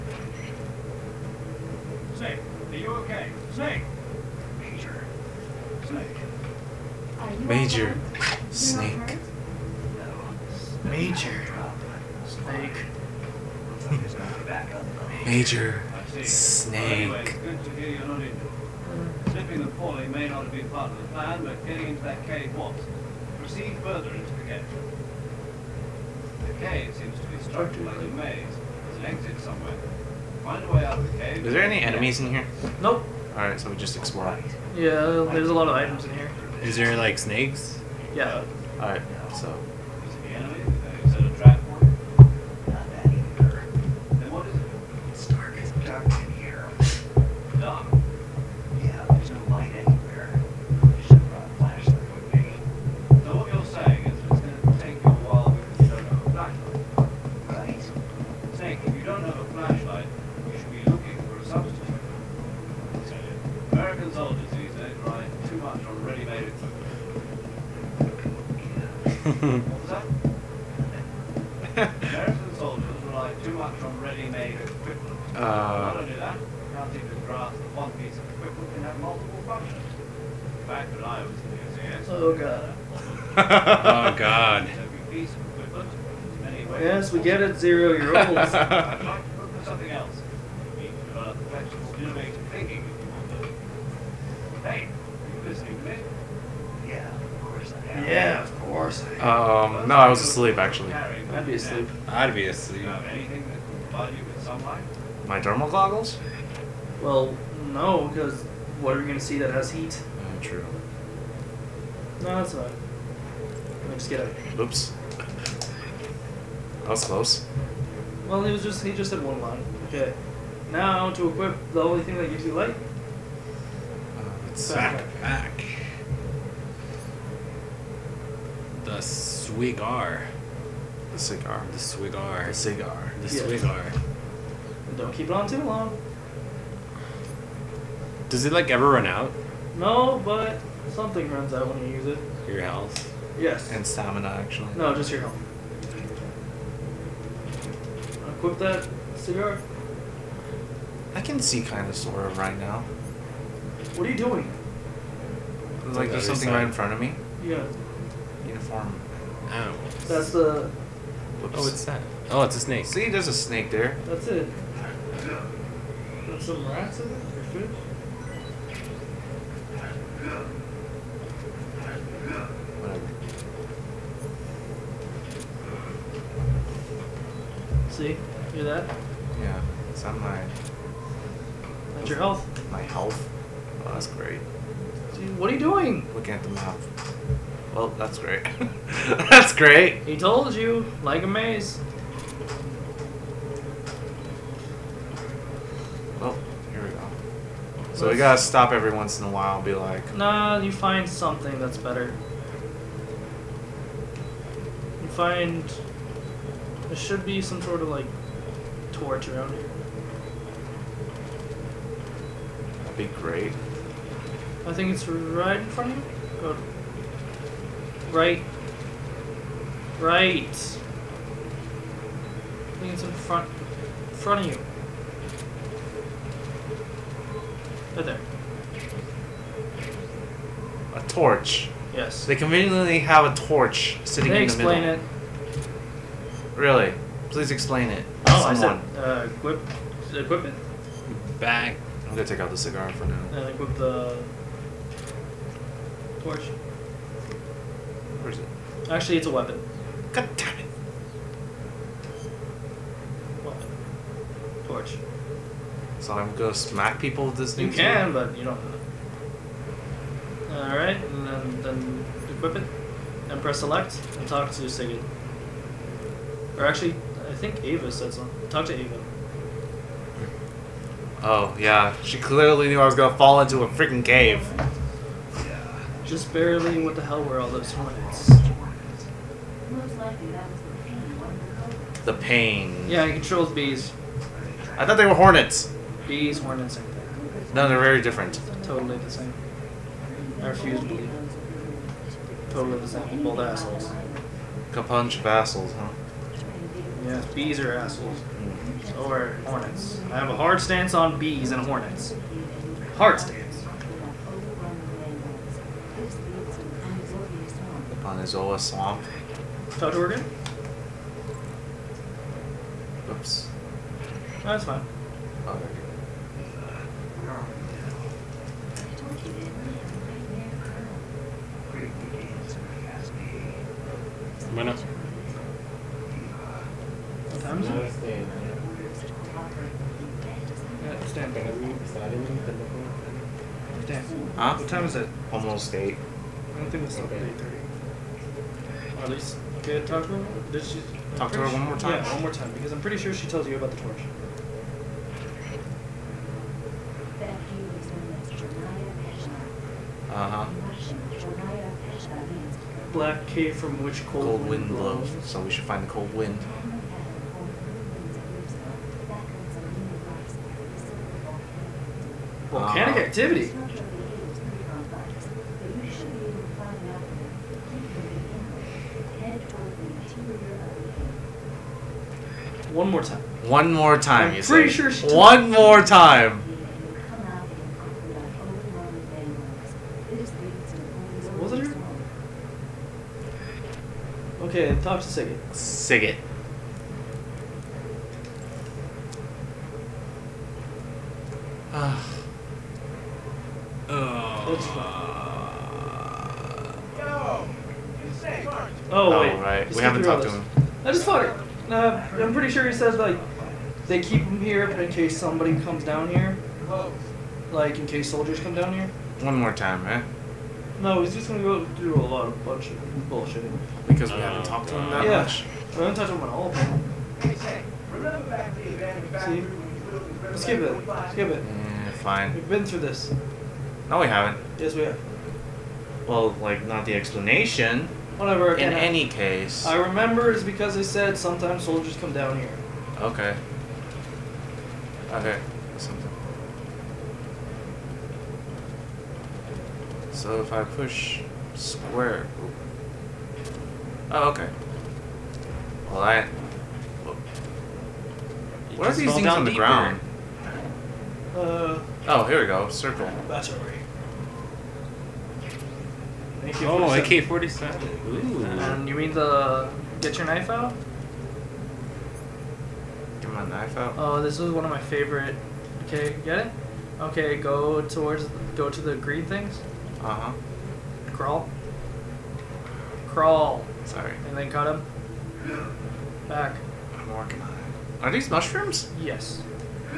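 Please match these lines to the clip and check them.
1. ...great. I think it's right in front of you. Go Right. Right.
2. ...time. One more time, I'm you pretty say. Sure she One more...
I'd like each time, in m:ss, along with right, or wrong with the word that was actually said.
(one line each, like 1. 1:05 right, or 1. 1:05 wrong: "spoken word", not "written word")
1. 3:33 right
2. 6:13 right.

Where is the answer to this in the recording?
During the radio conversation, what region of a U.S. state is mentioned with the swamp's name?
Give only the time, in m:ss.
5:09.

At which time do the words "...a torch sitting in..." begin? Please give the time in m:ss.
3:53.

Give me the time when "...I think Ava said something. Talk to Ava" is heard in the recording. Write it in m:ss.
4:27.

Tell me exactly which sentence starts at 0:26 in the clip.
The cave seems to be structured like a maze.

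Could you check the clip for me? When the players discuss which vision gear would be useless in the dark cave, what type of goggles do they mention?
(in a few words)
Thermal goggles.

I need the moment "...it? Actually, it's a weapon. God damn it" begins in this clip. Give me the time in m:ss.
4:08.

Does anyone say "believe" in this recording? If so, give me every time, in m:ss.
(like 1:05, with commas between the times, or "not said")
4:50.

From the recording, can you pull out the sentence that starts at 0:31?
Is there any enemies in here?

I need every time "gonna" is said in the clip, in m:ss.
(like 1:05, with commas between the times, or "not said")
4:02, 4:16, 4:32, 6:51.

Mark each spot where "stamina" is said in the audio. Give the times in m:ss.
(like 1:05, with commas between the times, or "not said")
2:23.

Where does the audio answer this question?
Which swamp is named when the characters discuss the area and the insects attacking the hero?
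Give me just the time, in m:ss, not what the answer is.
5:06.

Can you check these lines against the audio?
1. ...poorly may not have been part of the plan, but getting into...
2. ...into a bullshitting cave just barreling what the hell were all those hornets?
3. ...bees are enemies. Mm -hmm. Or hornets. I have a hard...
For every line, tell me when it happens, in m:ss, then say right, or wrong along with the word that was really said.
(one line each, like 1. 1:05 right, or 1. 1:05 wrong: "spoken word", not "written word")
1. 0:19 right
2. 4:33 wrong: "freaking", not "bullshitting"
3. 4:57 wrong: "assholes", not "enemies".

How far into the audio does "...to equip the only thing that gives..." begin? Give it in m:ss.
2:01.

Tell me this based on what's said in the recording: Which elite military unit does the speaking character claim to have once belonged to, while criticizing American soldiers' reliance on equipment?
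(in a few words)
SAS.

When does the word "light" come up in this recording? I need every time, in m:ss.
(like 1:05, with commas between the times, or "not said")
2:02.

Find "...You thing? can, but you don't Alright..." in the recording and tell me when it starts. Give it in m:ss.
4:17.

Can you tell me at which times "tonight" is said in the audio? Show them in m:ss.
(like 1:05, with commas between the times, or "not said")
not said.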